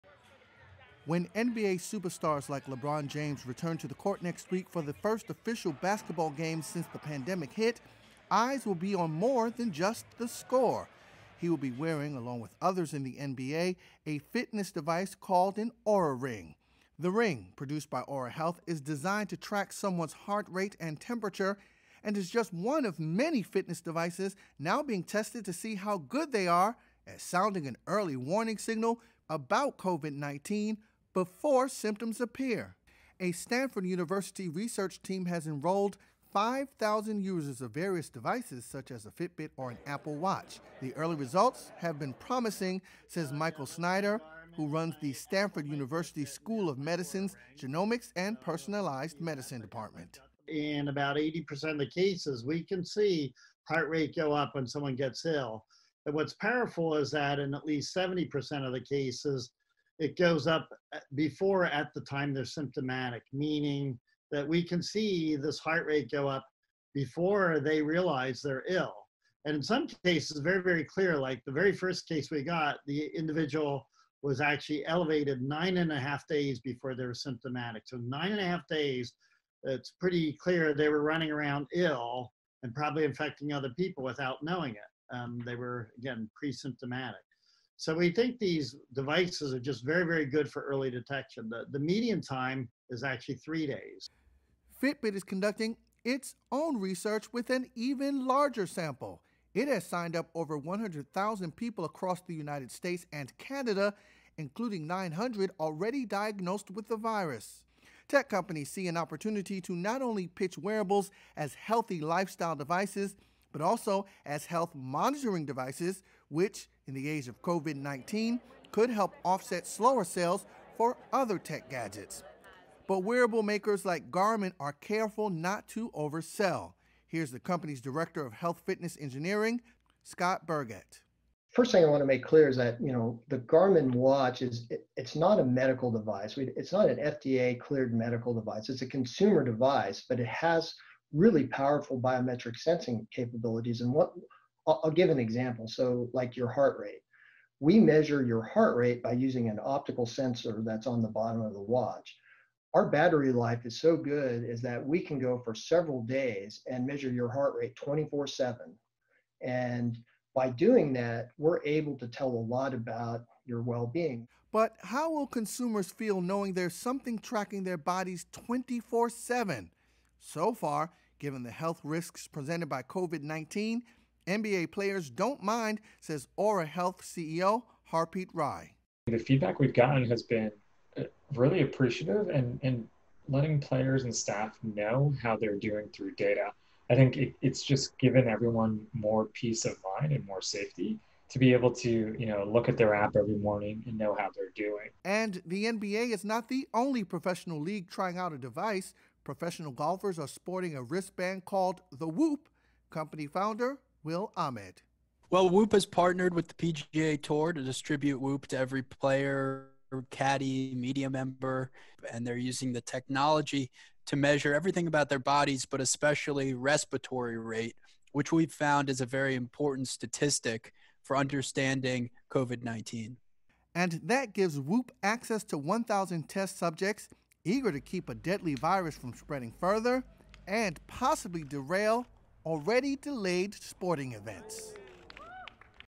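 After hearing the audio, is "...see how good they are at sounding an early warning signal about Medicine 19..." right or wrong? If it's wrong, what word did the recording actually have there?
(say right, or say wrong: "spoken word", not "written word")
wrong: "COVID", not "Medicine".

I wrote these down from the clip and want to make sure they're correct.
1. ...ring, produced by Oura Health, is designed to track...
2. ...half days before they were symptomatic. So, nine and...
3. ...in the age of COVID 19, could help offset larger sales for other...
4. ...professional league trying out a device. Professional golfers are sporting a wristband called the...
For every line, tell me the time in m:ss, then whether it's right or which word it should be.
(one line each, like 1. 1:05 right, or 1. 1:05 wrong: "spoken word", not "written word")
1. 0:17 right
2. 1:15 right
3. 1:56 wrong: "slower", not "larger"
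4. 3:17 right.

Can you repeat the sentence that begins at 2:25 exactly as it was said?
So, like your heart rate, we measure your heart rate by using an optical sensor that's on the bottom of the watch.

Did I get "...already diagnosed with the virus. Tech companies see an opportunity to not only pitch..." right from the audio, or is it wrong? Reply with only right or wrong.
right.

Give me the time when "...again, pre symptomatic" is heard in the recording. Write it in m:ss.
1:25.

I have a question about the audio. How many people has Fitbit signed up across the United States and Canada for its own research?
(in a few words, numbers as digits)
over 100,000.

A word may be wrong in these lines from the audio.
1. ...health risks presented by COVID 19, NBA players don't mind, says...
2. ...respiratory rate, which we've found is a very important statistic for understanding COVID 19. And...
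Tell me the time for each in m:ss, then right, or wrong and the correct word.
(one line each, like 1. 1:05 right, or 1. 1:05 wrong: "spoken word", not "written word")
1. 2:51 right
2. 3:36 right.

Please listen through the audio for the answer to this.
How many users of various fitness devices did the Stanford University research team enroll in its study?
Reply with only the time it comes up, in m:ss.
0:36.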